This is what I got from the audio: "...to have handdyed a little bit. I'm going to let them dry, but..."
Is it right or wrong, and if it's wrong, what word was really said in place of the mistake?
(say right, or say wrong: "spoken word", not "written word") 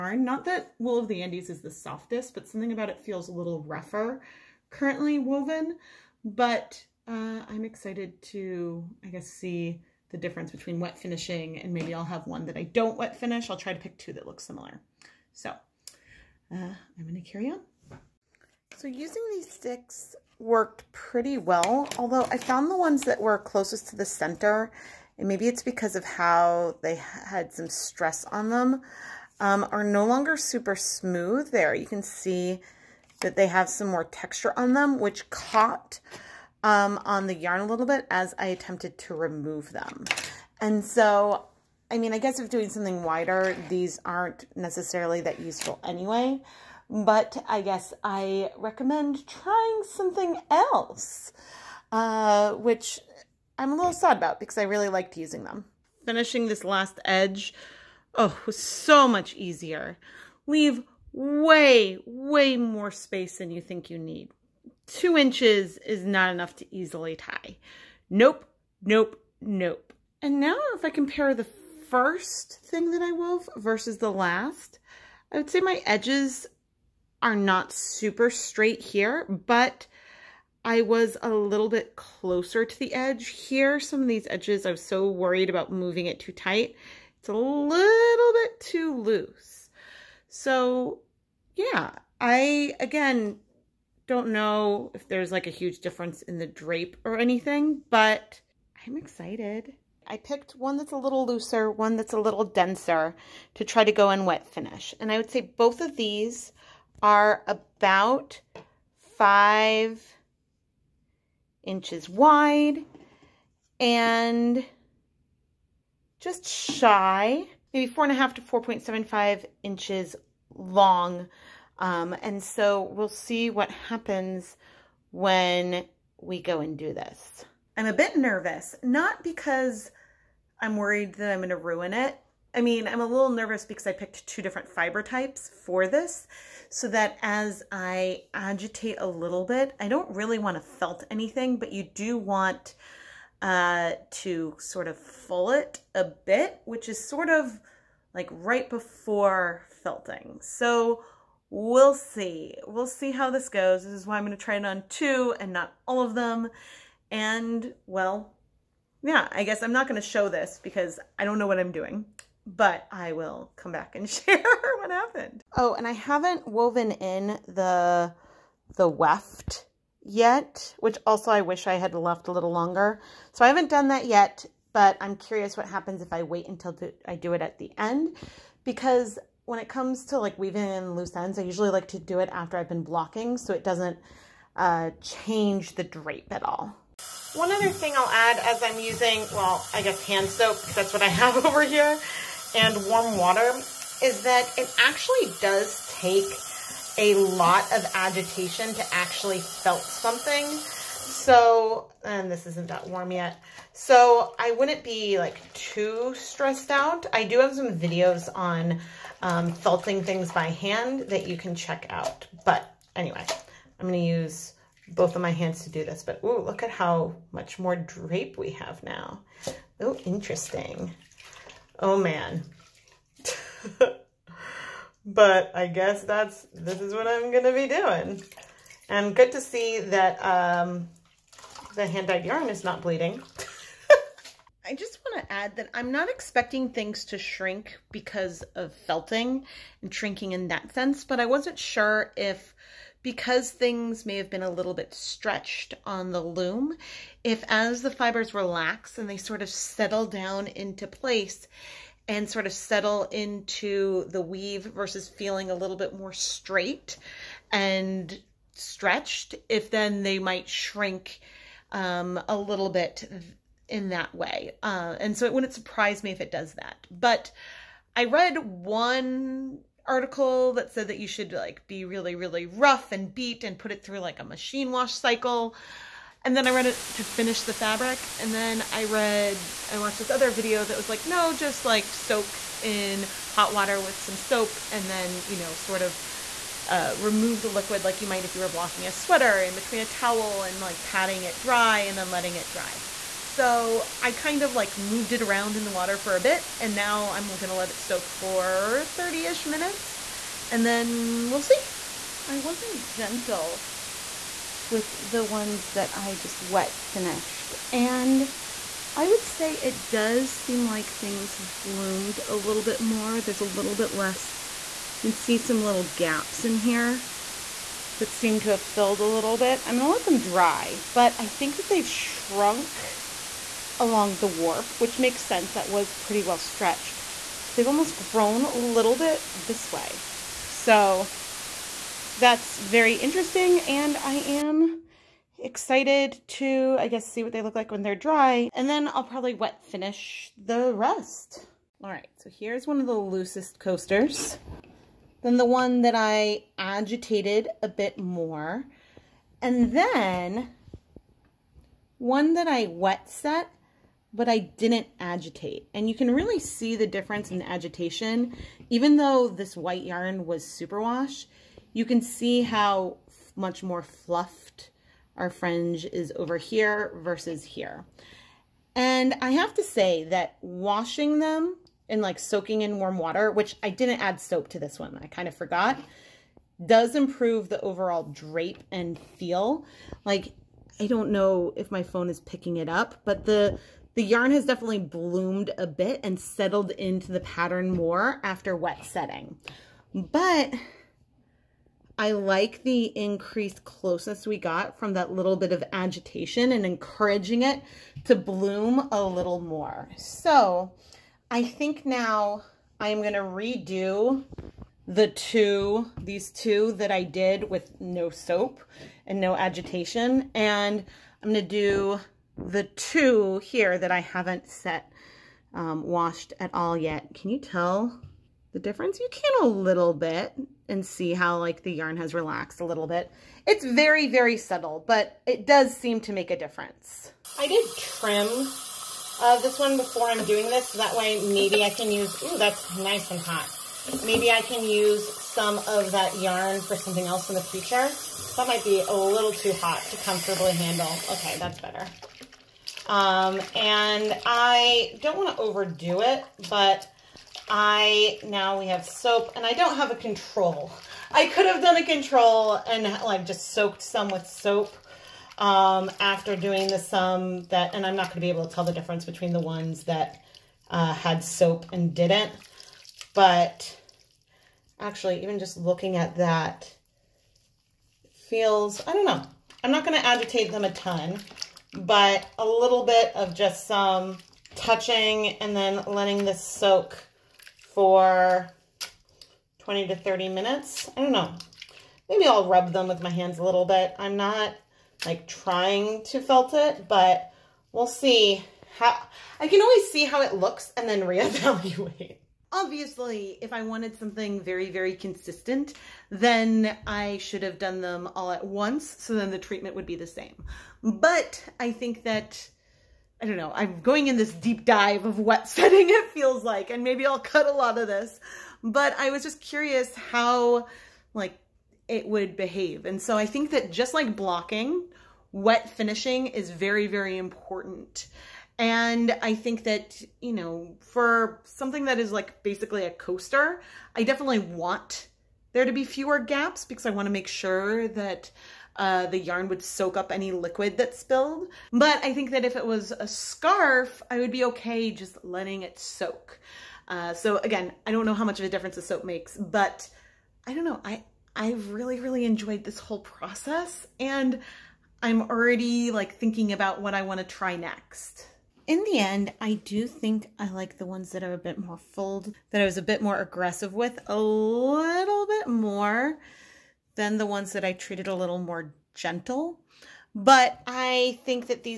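wrong: "filled", not "handdyed".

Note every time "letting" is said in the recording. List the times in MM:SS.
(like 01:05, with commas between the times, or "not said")
04:52, 07:55, 08:55.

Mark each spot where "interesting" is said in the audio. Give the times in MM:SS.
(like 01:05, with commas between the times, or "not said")
03:40, 05:32.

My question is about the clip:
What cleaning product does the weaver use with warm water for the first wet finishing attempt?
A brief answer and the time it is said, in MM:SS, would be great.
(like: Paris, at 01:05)
Hand soap, at 03:10.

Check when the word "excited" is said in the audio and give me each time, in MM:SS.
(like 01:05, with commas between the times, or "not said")
00:07, 01:38, 05:35.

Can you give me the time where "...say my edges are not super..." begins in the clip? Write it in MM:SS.
01:15.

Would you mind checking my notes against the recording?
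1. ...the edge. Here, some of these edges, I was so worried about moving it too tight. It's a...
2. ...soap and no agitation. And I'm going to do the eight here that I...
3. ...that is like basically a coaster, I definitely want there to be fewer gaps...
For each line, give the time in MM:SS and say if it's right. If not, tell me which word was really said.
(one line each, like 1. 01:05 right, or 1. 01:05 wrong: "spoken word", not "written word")
1. 01:22 right
2. 06:48 wrong: "two", not "eight"
3. 08:41 right.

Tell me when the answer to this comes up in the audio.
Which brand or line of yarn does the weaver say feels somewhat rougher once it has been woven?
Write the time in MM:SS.
00:00.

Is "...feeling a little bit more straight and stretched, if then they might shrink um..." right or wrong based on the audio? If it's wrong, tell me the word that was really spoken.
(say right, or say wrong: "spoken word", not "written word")
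right.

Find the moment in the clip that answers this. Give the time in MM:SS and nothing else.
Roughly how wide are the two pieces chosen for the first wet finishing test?
01:49.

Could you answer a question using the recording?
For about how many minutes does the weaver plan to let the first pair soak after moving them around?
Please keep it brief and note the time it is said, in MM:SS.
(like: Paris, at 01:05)
30 minutes, at 04:58.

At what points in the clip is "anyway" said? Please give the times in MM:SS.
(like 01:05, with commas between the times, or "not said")
00:45, 03:32.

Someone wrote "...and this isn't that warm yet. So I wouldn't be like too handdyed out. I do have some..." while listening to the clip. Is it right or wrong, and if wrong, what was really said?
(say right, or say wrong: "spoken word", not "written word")
wrong: "stressed", not "handdyed".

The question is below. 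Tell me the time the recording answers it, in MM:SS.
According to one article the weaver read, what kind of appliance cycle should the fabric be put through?
04:34.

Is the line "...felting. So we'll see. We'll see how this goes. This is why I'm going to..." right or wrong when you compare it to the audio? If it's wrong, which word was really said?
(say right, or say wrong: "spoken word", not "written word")
right.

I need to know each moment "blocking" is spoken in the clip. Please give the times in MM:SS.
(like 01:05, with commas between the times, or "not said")
03:02, 04:48, 08:34.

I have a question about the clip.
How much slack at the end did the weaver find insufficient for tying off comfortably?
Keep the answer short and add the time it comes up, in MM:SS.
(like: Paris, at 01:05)
2 inches, at 01:04.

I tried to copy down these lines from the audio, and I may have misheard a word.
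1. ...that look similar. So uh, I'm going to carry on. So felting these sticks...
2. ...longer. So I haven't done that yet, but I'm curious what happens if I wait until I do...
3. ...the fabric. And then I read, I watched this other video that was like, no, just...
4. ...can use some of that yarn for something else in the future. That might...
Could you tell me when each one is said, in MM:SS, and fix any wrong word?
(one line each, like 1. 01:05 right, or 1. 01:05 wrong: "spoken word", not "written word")
1. 00:14 wrong: "using", not "felting"
2. 02:52 right
3. 04:37 right
4. 07:14 right.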